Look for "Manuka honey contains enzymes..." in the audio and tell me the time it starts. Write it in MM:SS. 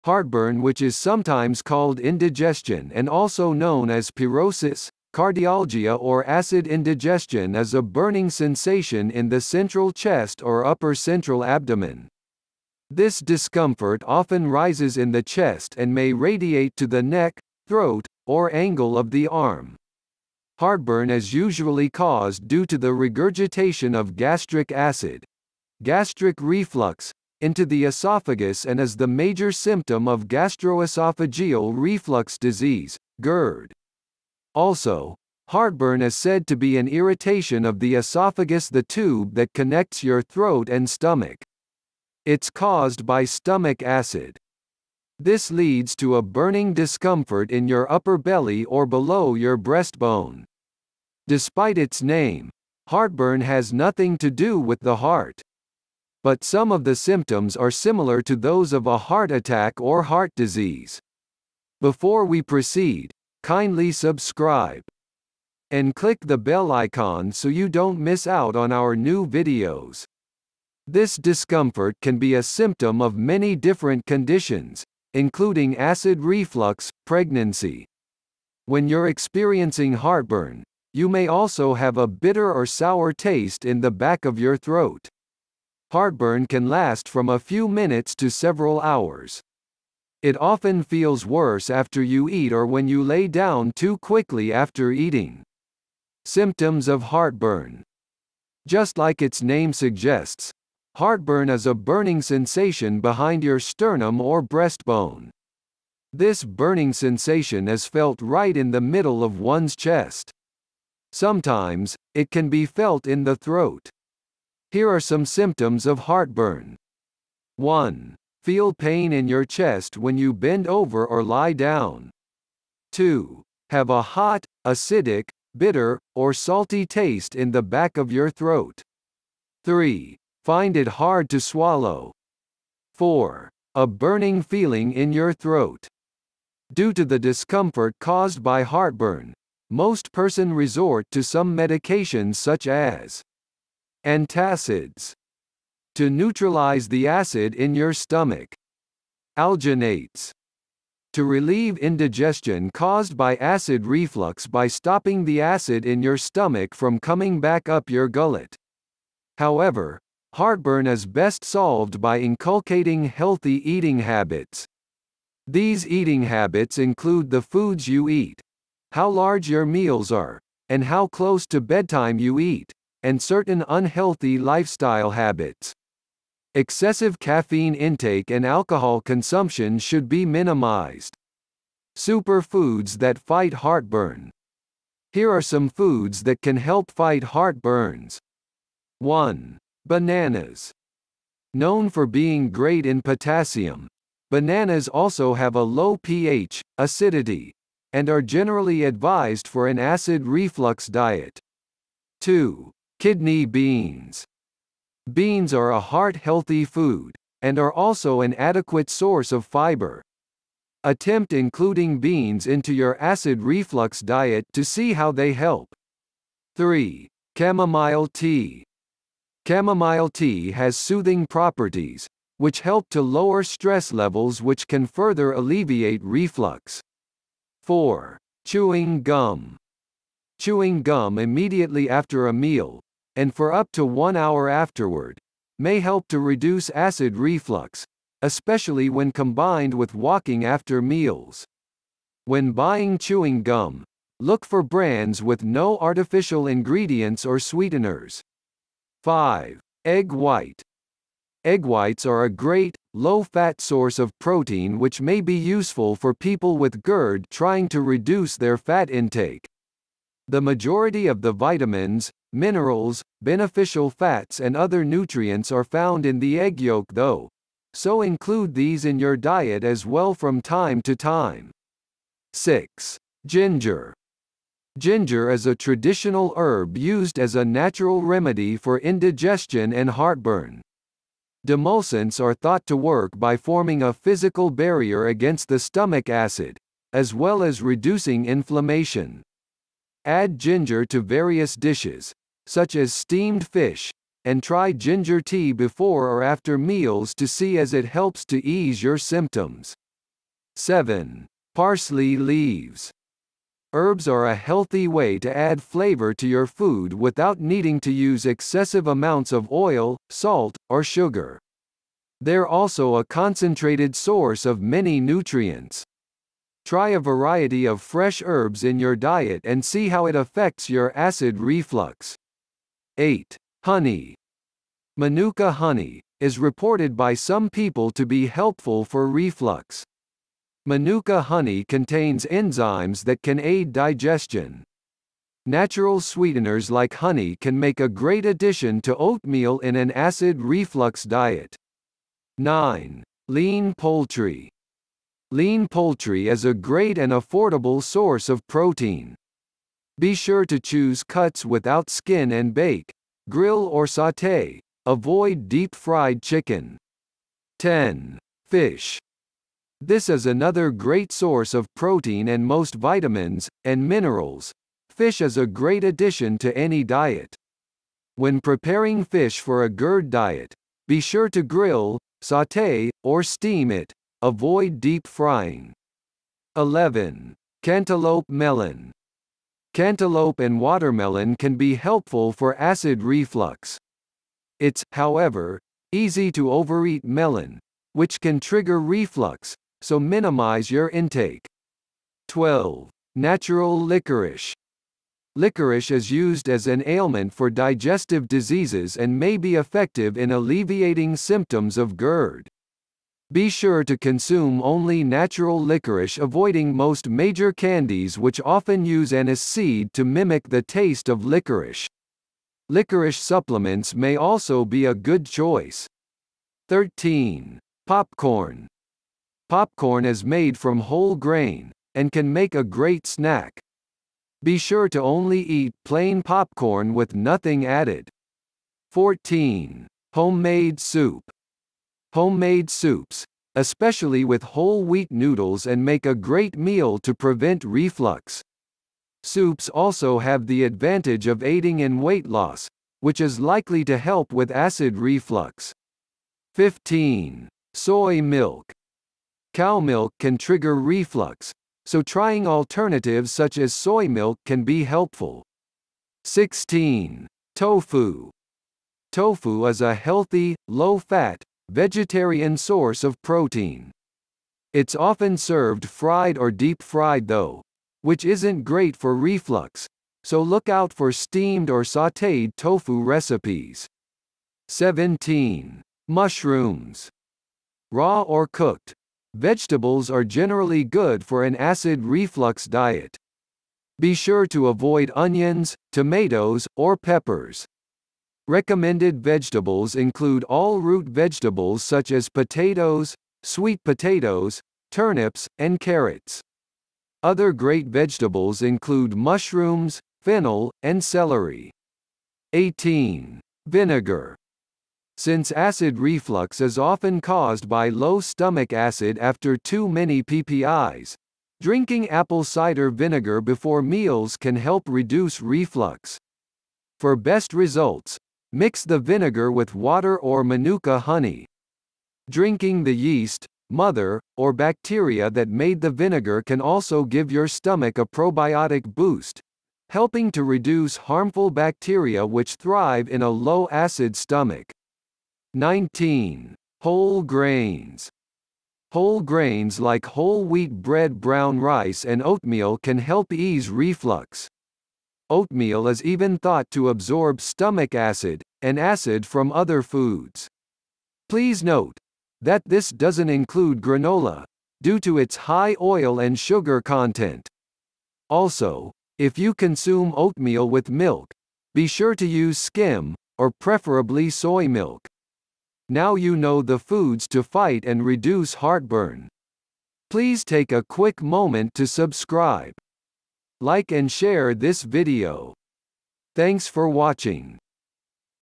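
05:30.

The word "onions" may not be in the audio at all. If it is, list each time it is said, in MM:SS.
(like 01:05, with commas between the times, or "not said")
08:05.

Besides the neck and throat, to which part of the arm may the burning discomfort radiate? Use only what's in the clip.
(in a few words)
Angle of the arm.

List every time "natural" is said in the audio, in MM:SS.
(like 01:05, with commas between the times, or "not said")
04:37, 05:35, 06:33, 06:45.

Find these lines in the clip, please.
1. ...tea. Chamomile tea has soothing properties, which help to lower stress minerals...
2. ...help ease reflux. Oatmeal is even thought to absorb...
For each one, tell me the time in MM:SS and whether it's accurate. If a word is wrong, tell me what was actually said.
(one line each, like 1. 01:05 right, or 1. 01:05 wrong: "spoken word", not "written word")
1. 03:38 wrong: "levels", not "minerals"
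2. 09:02 right.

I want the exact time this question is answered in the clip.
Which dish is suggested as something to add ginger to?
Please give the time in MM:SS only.
04:52.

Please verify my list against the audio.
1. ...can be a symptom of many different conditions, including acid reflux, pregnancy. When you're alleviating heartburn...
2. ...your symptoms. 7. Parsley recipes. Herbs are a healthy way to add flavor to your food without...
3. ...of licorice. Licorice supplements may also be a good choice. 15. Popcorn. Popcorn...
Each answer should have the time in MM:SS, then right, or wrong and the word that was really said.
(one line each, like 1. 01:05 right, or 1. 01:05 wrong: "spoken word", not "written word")
1. 01:12 wrong: "experiencing", not "alleviating"
2. 04:58 wrong: "leaves", not "recipes"
3. 06:51 wrong: "13", not "15".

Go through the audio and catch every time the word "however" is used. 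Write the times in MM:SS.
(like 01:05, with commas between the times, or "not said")
02:39, 06:24.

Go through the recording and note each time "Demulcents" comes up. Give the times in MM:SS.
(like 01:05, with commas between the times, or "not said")
04:41.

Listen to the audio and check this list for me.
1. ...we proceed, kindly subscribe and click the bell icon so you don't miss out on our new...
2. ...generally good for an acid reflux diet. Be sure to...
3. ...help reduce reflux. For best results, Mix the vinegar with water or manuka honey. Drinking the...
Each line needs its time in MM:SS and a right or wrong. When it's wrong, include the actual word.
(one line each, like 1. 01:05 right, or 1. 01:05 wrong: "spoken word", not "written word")
1. 01:02 right
2. 08:00 right
3. 08:34 right.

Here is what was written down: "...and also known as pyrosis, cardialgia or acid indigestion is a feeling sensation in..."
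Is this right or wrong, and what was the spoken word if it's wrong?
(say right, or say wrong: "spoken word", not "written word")
wrong: "burning", not "feeling".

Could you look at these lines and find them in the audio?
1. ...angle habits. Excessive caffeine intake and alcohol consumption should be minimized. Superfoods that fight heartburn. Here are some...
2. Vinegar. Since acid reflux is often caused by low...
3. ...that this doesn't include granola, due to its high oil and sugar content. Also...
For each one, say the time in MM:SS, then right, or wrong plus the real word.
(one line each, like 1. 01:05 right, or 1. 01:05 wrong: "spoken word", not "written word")
1. 02:54 wrong: "lifestyle", not "angle"
2. 08:23 right
3. 09:12 right.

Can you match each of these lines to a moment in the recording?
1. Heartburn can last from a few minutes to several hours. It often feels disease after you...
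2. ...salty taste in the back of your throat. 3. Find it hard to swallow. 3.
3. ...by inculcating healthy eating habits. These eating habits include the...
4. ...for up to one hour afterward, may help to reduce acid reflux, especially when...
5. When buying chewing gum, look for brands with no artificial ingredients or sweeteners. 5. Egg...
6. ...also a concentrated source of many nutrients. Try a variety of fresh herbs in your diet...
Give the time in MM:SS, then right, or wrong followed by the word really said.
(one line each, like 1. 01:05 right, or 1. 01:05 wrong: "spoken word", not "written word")
1. 01:25 wrong: "worse", not "disease"
2. 02:06 wrong: "4", not "3"
3. 02:42 right
4. 03:53 right
5. 04:02 right
6. 05:12 right.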